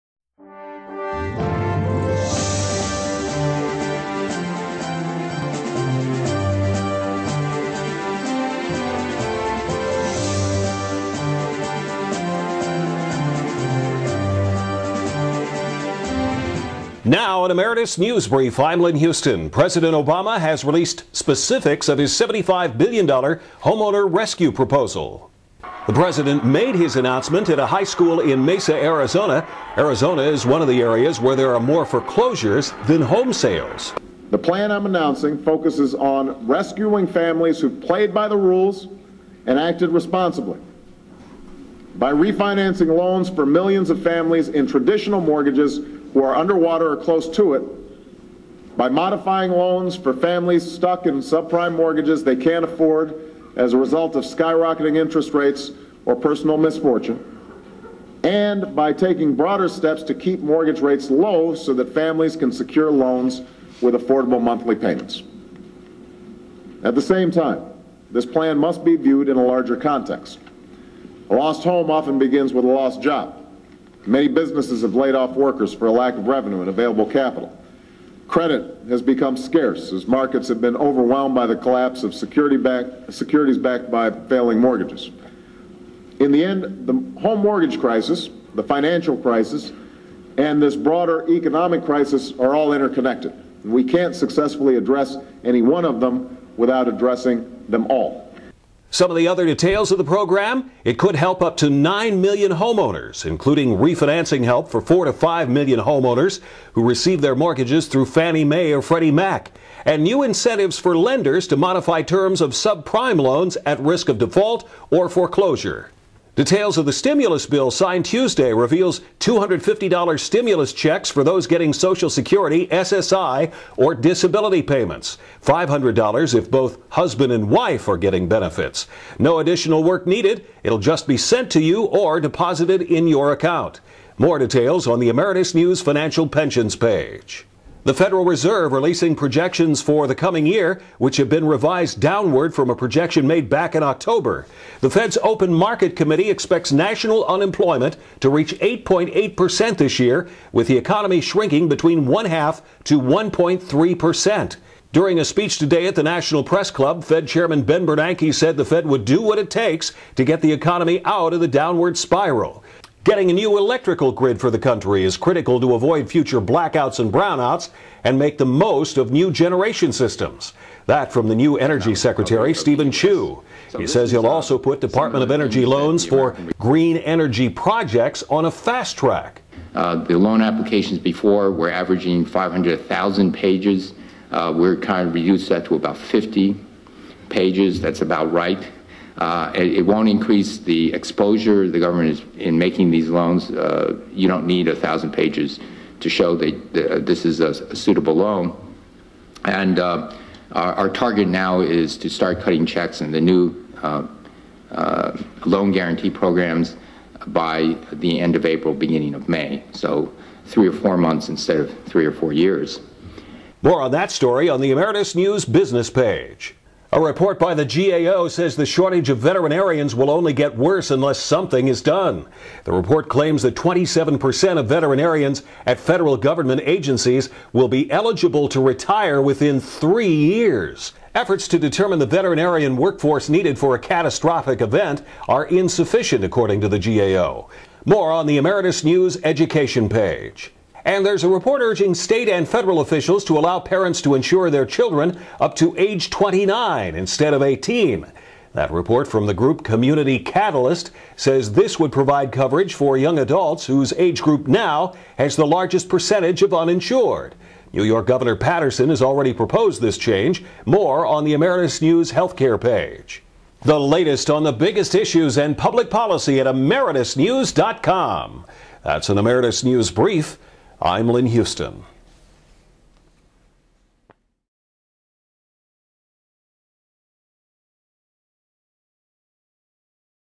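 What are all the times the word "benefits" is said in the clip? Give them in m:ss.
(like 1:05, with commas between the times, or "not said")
2:08.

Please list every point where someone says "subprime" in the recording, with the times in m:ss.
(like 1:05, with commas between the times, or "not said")
0:51, 1:52.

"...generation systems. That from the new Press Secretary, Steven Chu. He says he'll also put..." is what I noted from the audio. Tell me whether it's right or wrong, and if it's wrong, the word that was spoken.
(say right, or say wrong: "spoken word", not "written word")
wrong: "Energy", not "Press".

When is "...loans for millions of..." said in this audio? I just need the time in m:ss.
0:42.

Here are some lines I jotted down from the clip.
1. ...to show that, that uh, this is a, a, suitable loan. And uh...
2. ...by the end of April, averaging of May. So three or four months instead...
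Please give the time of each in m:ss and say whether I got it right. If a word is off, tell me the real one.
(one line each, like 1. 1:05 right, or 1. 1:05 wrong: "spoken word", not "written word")
1. 3:15 right
2. 3:27 wrong: "beginning", not "averaging".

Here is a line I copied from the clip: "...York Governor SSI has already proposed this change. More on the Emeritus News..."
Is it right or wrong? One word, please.
wrong.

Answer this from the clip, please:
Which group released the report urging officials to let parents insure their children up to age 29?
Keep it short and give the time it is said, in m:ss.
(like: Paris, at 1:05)
Community Catalyst, at 4:09.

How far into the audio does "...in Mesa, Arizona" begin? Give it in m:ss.
0:28.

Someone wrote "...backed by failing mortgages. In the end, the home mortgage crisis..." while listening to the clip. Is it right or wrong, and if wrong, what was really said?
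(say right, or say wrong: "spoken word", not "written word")
right.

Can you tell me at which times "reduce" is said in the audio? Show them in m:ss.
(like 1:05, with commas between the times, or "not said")
3:05.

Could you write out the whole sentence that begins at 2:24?
The Fed's Open Market Committee expects national unemployment to reach 8.8% this year, with the economy shrinking between one half to 1.3%.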